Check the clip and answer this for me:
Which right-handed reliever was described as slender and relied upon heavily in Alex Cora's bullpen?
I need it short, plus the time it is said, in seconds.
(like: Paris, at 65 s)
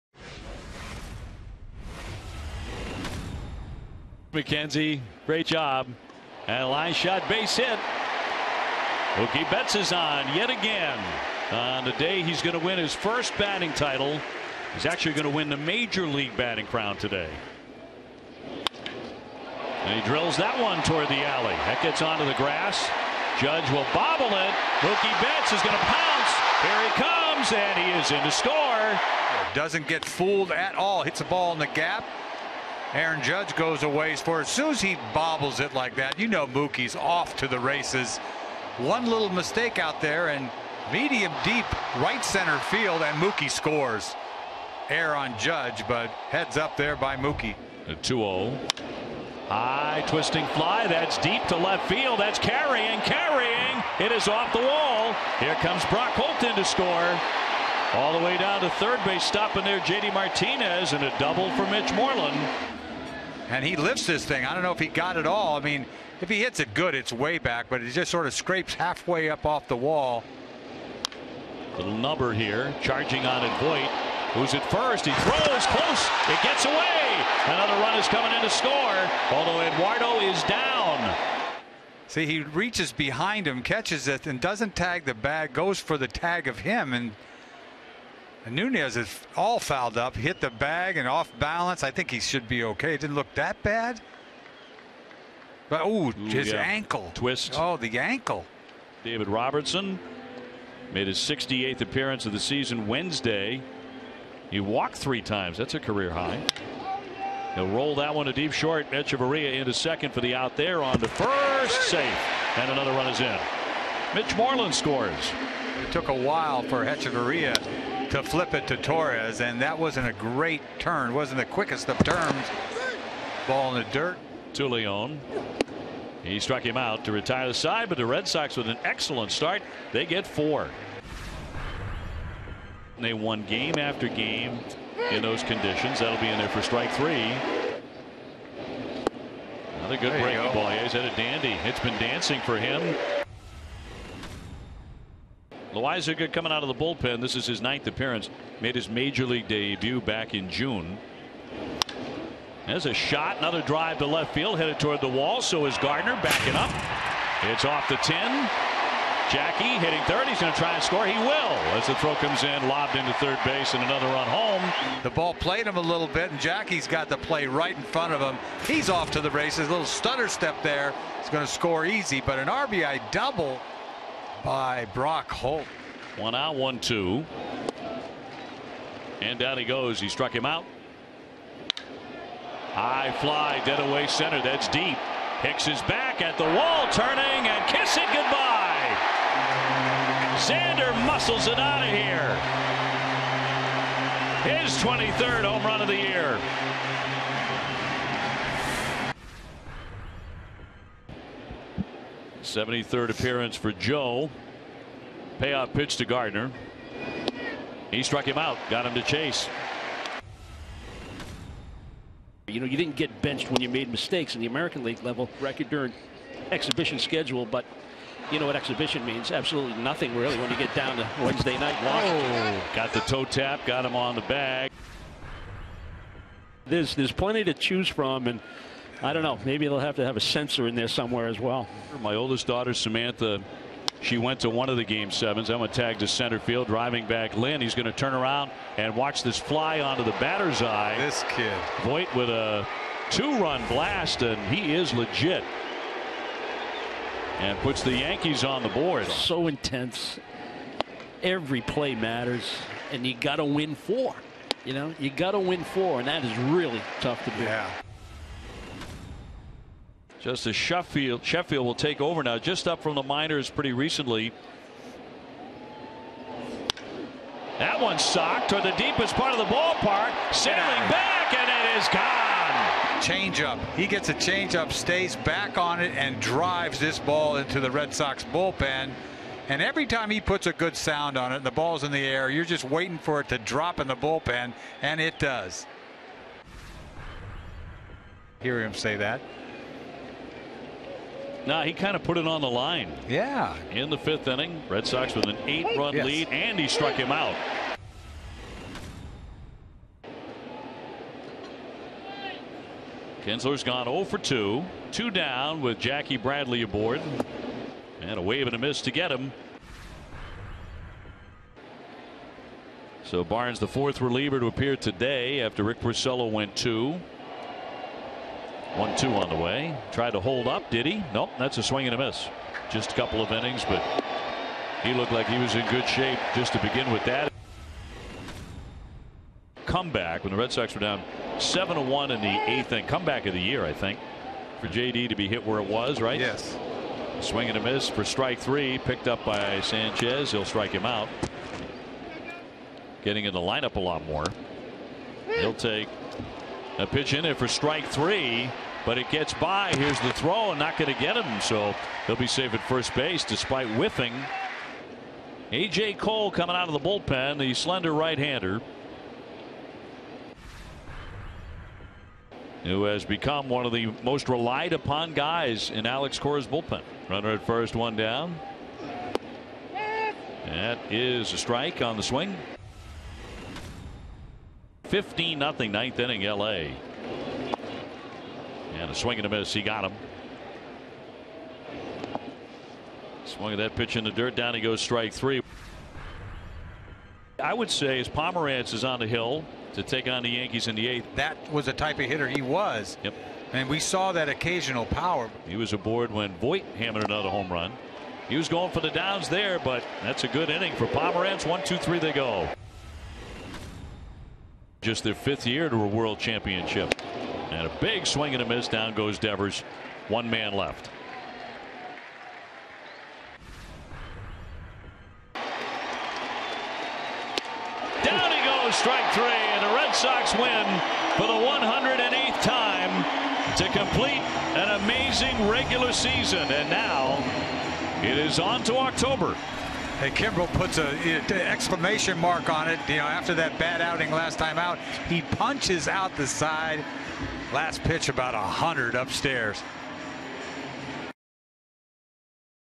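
A.J. Cole, at 355 s.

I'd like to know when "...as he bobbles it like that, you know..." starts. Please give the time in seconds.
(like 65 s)
34 s.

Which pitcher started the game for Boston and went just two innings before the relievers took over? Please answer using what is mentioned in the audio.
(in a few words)
Rick Porcello.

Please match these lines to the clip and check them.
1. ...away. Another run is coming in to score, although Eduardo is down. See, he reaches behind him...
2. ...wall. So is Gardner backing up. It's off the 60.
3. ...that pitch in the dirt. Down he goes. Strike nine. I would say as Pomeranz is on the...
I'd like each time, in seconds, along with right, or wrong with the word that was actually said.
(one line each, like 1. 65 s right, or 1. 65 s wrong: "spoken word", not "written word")
1. 76 s right
2. 155 s wrong: "10", not "60"
3. 383 s wrong: "three", not "nine".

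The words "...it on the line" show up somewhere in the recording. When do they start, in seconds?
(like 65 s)
292 s.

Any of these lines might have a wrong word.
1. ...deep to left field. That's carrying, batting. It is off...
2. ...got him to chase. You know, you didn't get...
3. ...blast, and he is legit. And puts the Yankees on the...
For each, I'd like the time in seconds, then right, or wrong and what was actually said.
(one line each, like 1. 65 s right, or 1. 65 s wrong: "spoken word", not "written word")
1. 51 s wrong: "carrying", not "batting"
2. 208 s right
3. 243 s right.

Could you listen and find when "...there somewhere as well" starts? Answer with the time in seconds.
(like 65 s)
230 s.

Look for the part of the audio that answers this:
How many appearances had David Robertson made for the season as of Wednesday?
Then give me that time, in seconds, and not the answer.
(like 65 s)
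101 s.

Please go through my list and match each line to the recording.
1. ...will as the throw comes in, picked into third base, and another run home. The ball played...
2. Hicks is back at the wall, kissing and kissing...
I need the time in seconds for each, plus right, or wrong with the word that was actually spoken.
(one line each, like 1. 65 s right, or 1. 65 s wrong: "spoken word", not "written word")
1. 161 s wrong: "lobbed", not "picked"
2. 185 s wrong: "turning", not "kissing".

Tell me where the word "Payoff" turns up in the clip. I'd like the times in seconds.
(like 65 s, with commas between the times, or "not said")
205 s.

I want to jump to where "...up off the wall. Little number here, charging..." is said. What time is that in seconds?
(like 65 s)
69 s.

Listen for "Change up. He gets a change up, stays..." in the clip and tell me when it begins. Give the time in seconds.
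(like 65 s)
273 s.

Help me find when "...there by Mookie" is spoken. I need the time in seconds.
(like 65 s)
46 s.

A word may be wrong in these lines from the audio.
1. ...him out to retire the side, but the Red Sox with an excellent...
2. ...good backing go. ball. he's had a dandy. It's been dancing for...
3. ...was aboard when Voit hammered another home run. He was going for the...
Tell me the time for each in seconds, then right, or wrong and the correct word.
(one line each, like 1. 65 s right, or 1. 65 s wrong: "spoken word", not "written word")
1. 126 s right
2. 139 s wrong: "breaking", not "backing"
3. 395 s right.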